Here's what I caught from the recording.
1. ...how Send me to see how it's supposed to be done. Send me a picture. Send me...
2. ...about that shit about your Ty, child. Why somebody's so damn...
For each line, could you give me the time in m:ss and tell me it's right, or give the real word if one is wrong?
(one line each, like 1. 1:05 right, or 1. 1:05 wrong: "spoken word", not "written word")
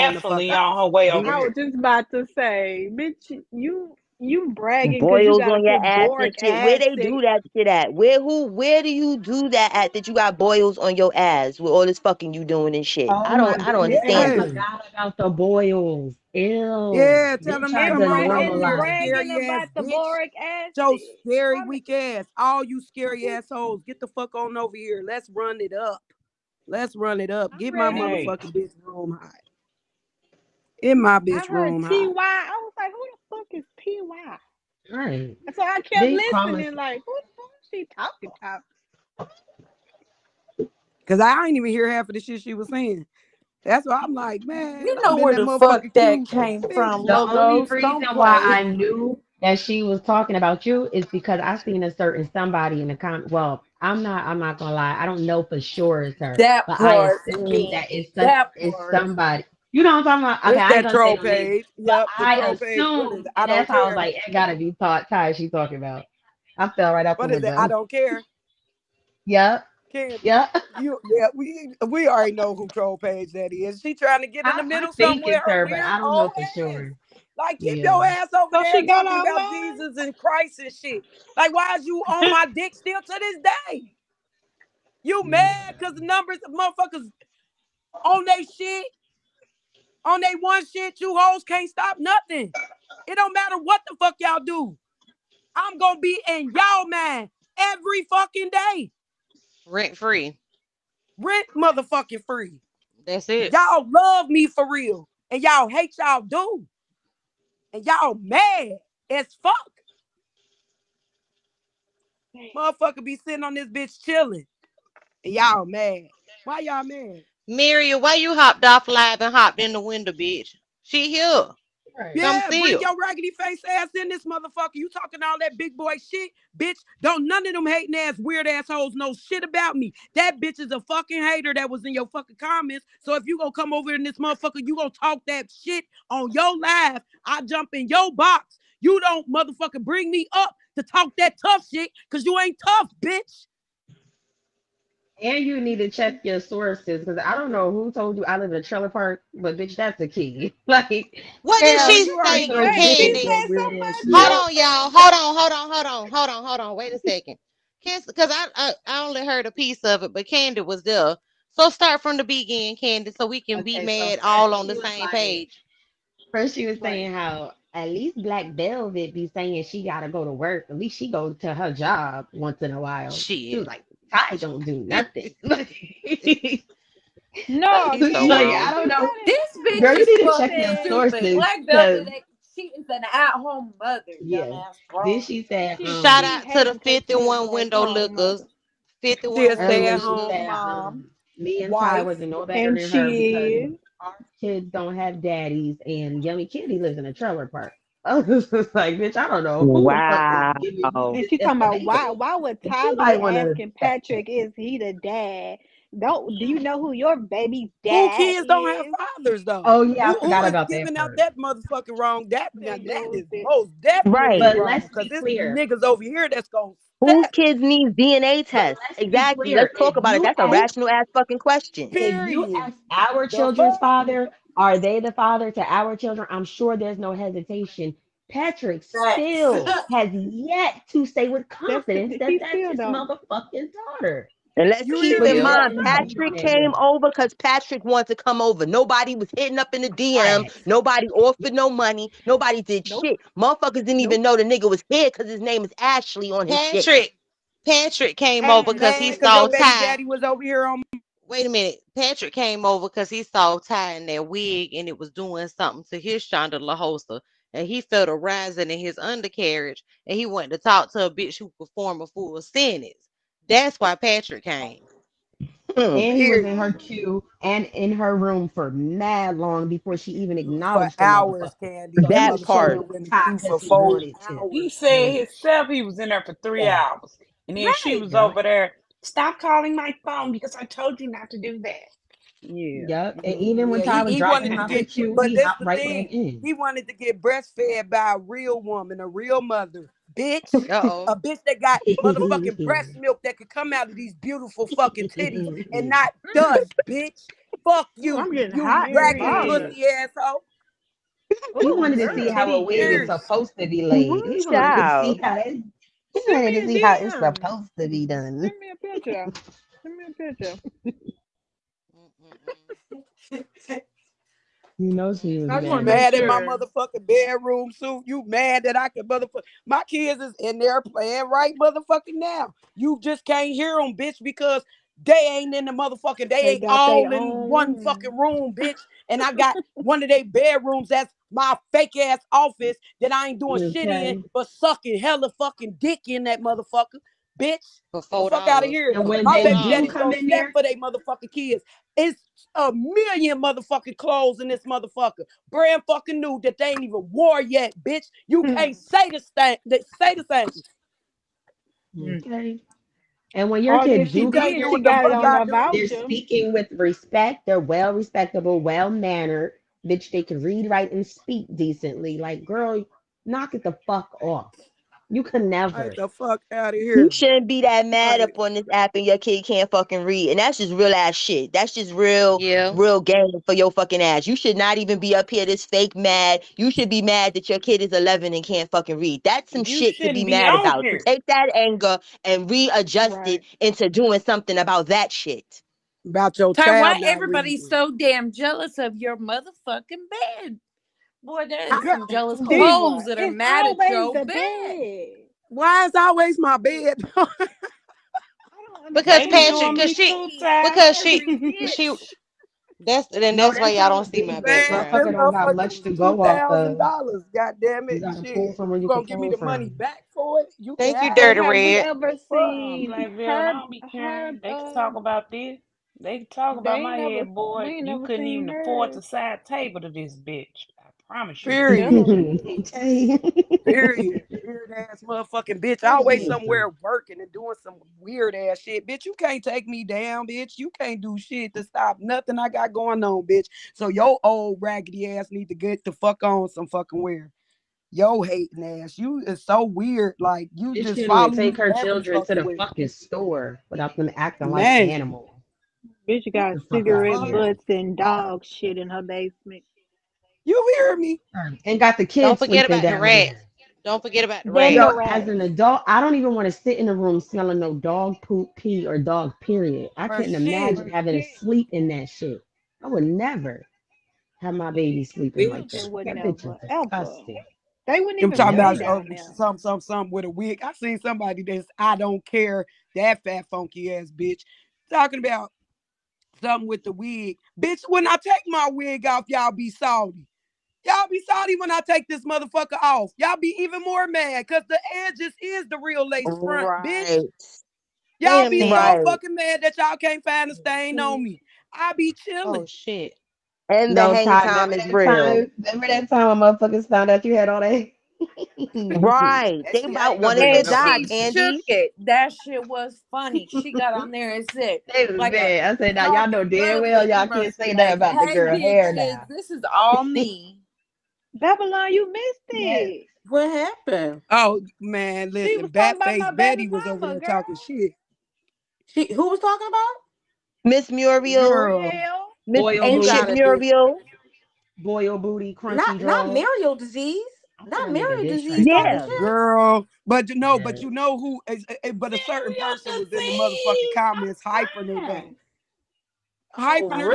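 1. 5:05 right
2. 6:24 wrong: "everybody", not "somebody".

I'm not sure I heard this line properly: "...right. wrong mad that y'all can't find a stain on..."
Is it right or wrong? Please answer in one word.
wrong.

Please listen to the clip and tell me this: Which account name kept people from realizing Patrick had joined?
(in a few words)
Ashley.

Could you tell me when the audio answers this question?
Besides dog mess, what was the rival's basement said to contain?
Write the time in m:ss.
7:26.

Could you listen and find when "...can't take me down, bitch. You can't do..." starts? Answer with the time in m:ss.
7:09.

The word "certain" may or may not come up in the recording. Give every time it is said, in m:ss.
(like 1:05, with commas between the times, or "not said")
0:51, 8:52.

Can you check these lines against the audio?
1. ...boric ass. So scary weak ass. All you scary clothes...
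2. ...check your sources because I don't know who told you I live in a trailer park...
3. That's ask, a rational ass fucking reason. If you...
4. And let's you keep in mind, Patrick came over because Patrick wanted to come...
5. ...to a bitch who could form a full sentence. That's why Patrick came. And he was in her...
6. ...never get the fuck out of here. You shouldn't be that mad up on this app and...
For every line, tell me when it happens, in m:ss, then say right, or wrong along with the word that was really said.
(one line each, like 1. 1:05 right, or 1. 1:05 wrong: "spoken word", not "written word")
1. 0:19 wrong: "assholes", not "clothes"
2. 2:25 right
3. 3:40 wrong: "question", not "reason"
4. 3:54 right
5. 4:20 right
6. 6:05 right.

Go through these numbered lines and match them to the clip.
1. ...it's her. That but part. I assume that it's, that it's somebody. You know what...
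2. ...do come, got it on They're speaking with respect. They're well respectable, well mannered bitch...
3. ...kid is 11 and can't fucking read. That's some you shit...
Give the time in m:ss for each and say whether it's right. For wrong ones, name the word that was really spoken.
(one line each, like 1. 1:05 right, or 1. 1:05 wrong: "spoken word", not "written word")
1. 0:56 right
2. 5:54 right
3. 6:17 right.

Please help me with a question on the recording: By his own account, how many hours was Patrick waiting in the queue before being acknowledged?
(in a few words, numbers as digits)
3.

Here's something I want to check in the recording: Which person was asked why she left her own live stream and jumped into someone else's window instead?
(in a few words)
Maria.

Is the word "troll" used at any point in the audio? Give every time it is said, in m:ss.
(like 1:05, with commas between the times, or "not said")
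1:00, 1:12.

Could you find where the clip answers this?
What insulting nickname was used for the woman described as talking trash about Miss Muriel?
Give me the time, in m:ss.
8:35.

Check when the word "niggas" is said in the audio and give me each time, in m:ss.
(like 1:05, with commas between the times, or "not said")
3:35, 4:04.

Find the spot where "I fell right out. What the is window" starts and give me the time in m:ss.
1:06.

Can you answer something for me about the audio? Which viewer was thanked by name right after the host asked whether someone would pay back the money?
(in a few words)
Dirty Red.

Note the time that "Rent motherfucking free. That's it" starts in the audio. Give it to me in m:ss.
1:41.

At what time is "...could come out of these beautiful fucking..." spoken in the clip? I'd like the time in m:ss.
4:53.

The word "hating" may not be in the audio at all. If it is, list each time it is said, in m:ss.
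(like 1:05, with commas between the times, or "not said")
2:07, 7:18.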